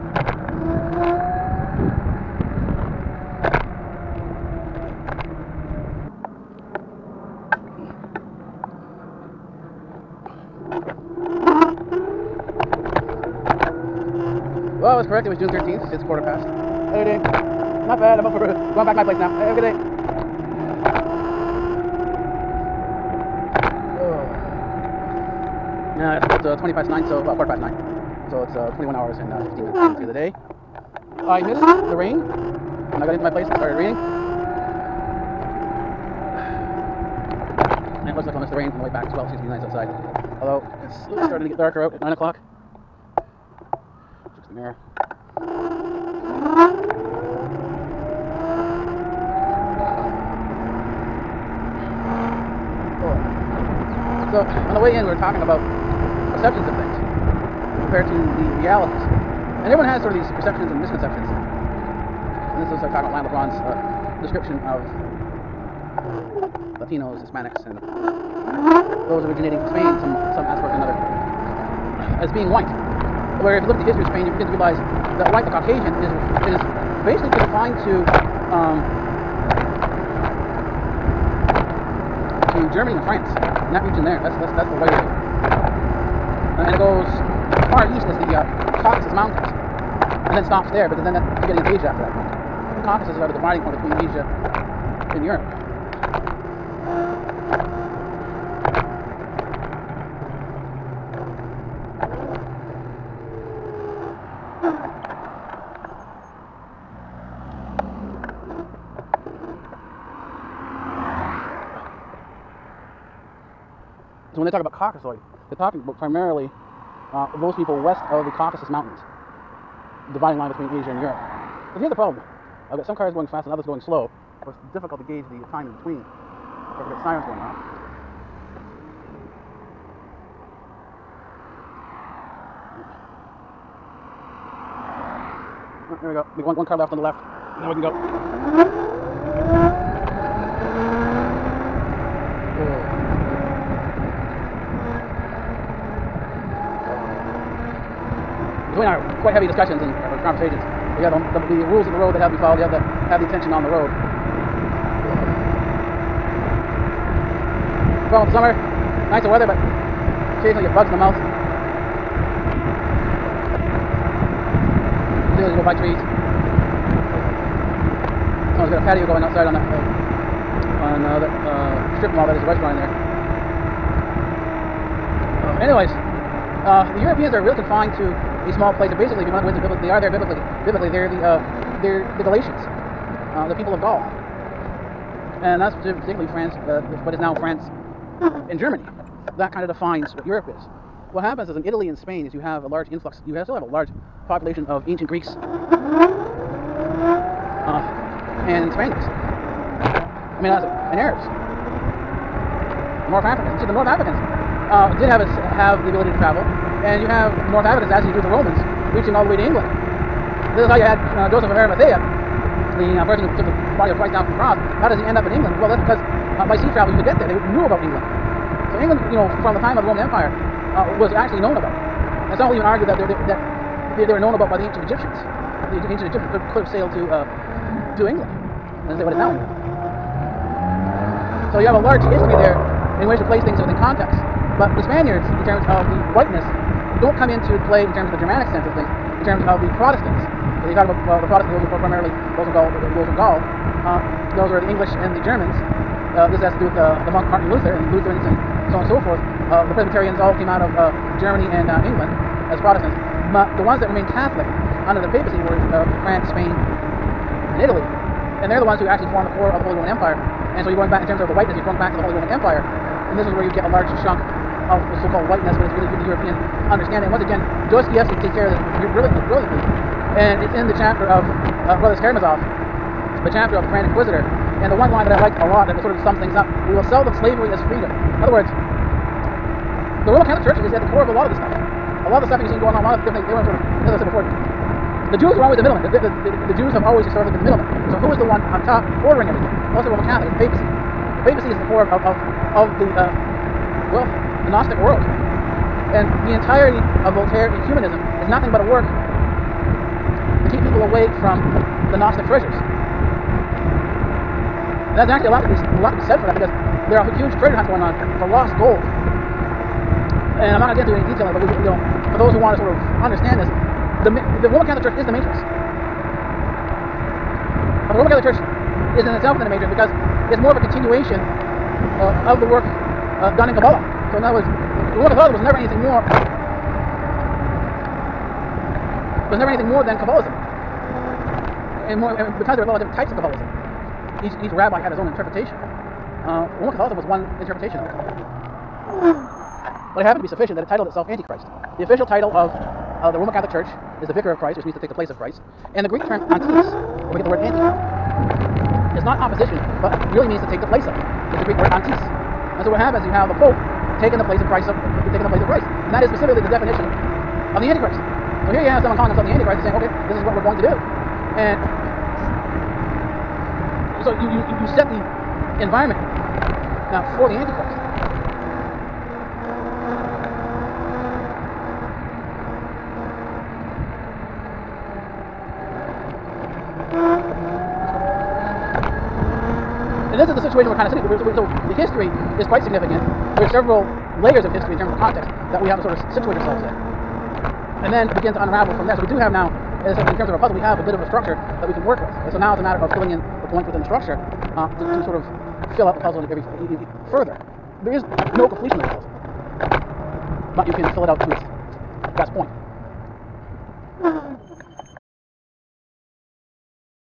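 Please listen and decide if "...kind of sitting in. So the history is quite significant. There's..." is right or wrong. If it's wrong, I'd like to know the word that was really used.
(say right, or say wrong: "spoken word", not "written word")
right.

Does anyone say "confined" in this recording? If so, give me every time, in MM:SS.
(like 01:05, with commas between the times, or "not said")
01:17, 02:57.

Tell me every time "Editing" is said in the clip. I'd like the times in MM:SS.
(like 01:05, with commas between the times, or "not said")
00:16.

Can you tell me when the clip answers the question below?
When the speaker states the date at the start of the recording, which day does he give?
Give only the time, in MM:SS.
00:15.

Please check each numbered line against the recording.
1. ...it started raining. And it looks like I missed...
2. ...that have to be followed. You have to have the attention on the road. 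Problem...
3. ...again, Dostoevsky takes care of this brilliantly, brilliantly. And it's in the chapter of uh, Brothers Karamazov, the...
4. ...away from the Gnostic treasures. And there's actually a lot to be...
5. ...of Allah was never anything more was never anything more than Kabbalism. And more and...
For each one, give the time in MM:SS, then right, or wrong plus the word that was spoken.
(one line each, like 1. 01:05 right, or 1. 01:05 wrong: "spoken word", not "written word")
1. 00:33 right
2. 02:32 right
3. 04:27 right
4. 05:00 right
5. 05:25 right.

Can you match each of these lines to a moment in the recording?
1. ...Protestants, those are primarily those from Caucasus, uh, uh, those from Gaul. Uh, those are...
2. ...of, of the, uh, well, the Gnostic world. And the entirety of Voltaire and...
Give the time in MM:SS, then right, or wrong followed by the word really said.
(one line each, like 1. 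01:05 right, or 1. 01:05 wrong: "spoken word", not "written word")
1. 04:01 wrong: "Gaul", not "Caucasus"
2. 04:52 right.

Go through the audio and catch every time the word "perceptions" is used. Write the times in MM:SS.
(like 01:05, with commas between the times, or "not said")
00:56, 01:00.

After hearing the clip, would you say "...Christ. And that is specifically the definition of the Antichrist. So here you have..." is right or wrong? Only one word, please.
right.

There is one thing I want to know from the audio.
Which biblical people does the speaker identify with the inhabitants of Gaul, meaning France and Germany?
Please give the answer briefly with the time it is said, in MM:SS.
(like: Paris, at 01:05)
Galatians, at 03:02.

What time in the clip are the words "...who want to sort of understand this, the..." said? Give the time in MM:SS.
05:12.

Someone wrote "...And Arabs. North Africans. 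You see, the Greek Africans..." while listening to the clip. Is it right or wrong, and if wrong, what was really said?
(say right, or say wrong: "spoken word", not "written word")
wrong: "North", not "Greek".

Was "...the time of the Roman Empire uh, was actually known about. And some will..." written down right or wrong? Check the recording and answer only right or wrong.
right.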